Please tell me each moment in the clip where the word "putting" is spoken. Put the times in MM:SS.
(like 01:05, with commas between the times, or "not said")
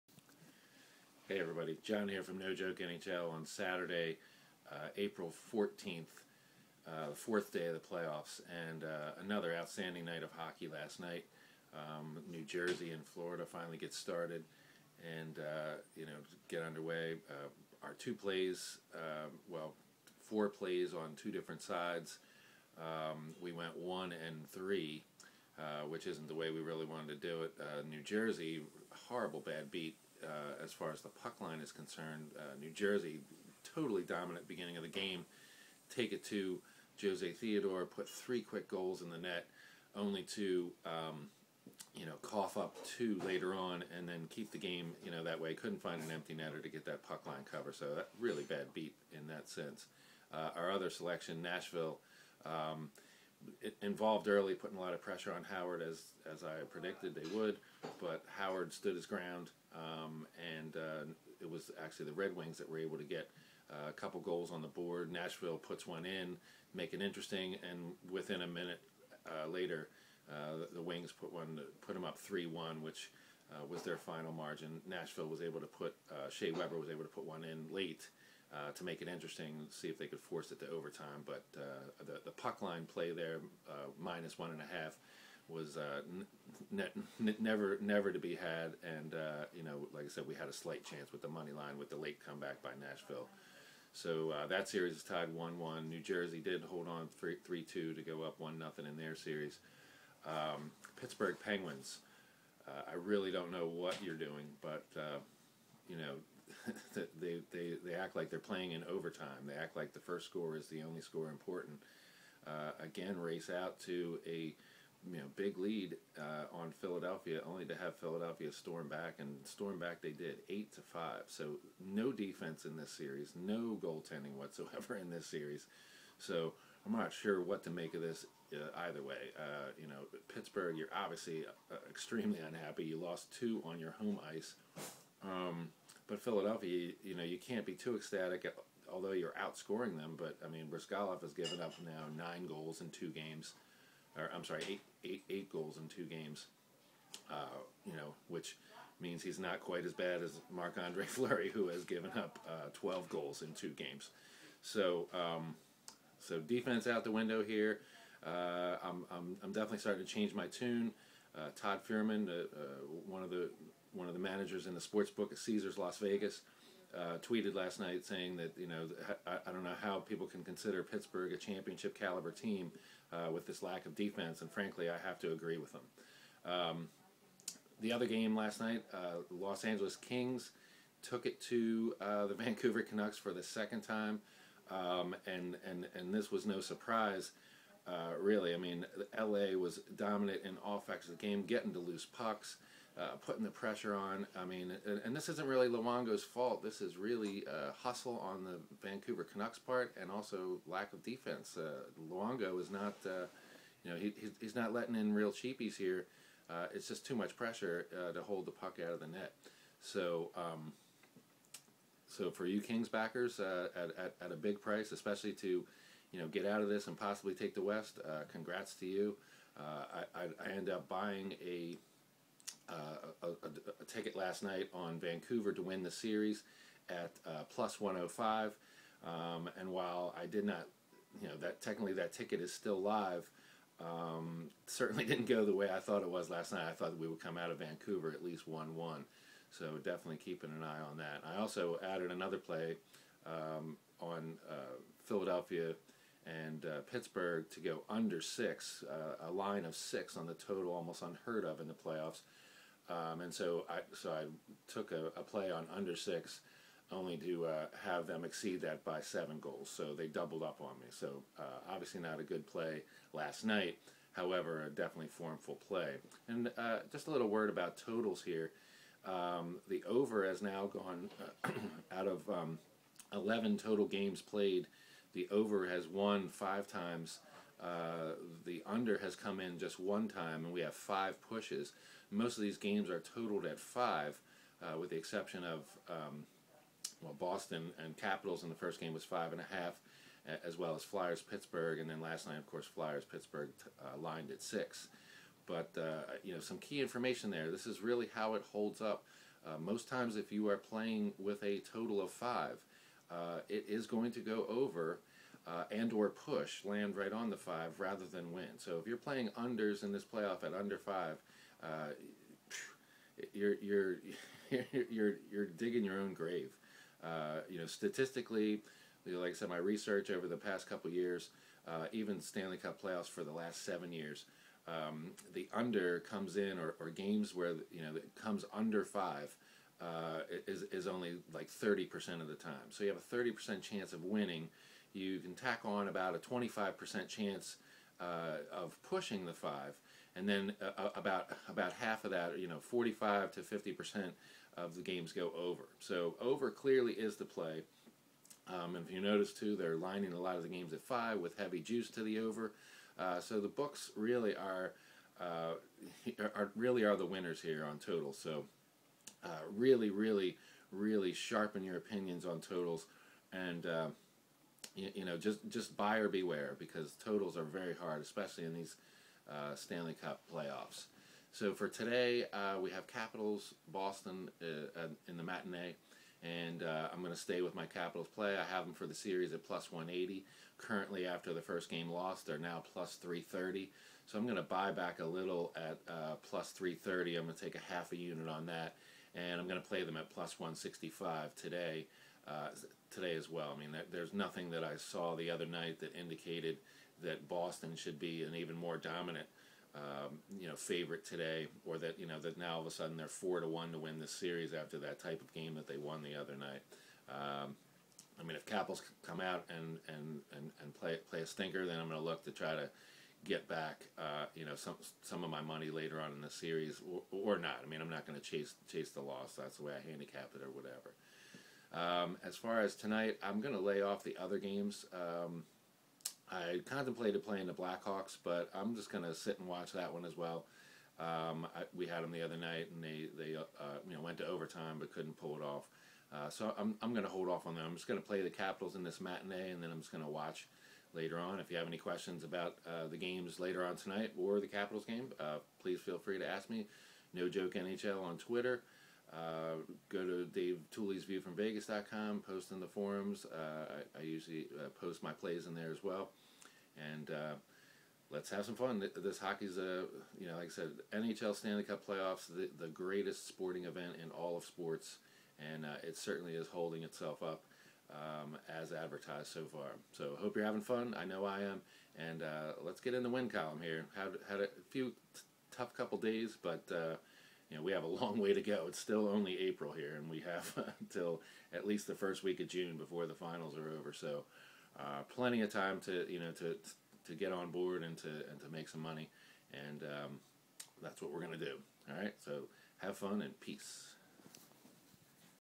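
00:54, 03:13.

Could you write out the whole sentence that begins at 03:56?
I thought we would come out of Vancouver at least 1 1.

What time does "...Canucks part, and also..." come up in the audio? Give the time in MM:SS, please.
03:19.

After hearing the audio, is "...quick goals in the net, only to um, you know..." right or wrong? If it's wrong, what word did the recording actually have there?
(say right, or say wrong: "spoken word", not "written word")
right.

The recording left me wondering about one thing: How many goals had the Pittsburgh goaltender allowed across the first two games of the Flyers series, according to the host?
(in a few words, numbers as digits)
12.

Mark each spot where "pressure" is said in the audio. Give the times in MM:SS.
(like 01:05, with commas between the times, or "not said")
00:55, 03:13, 03:27.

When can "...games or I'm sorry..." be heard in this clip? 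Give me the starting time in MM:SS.
02:23.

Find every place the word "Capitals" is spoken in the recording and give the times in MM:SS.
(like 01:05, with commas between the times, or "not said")
04:47, 06:12, 06:17, 07:18, 07:24.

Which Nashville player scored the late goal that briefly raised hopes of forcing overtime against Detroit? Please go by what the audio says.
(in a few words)
Shea Weber.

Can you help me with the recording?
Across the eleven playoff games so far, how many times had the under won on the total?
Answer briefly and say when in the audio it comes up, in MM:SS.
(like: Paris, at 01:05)
1, at 04:39.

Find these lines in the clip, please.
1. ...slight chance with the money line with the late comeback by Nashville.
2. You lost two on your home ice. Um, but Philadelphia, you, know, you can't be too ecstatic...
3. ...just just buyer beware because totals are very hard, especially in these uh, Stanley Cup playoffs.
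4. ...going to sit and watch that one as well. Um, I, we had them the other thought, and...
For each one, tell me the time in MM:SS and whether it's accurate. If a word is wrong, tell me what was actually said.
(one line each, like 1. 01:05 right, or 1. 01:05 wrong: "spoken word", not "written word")
1. 01:30 right
2. 02:12 right
3. 06:05 right
4. 07:08 wrong: "night", not "thought".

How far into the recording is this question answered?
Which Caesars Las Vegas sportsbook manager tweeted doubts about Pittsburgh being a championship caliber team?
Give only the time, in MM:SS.
02:41.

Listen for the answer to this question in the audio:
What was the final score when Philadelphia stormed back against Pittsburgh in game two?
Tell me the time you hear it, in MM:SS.
02:00.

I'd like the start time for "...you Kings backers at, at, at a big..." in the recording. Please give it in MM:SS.
03:32.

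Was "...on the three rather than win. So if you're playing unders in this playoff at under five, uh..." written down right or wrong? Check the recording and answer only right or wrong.
wrong.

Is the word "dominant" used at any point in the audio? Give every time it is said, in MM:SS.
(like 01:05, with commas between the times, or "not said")
00:34, 03:09, 06:38.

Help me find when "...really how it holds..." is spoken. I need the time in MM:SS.
04:57.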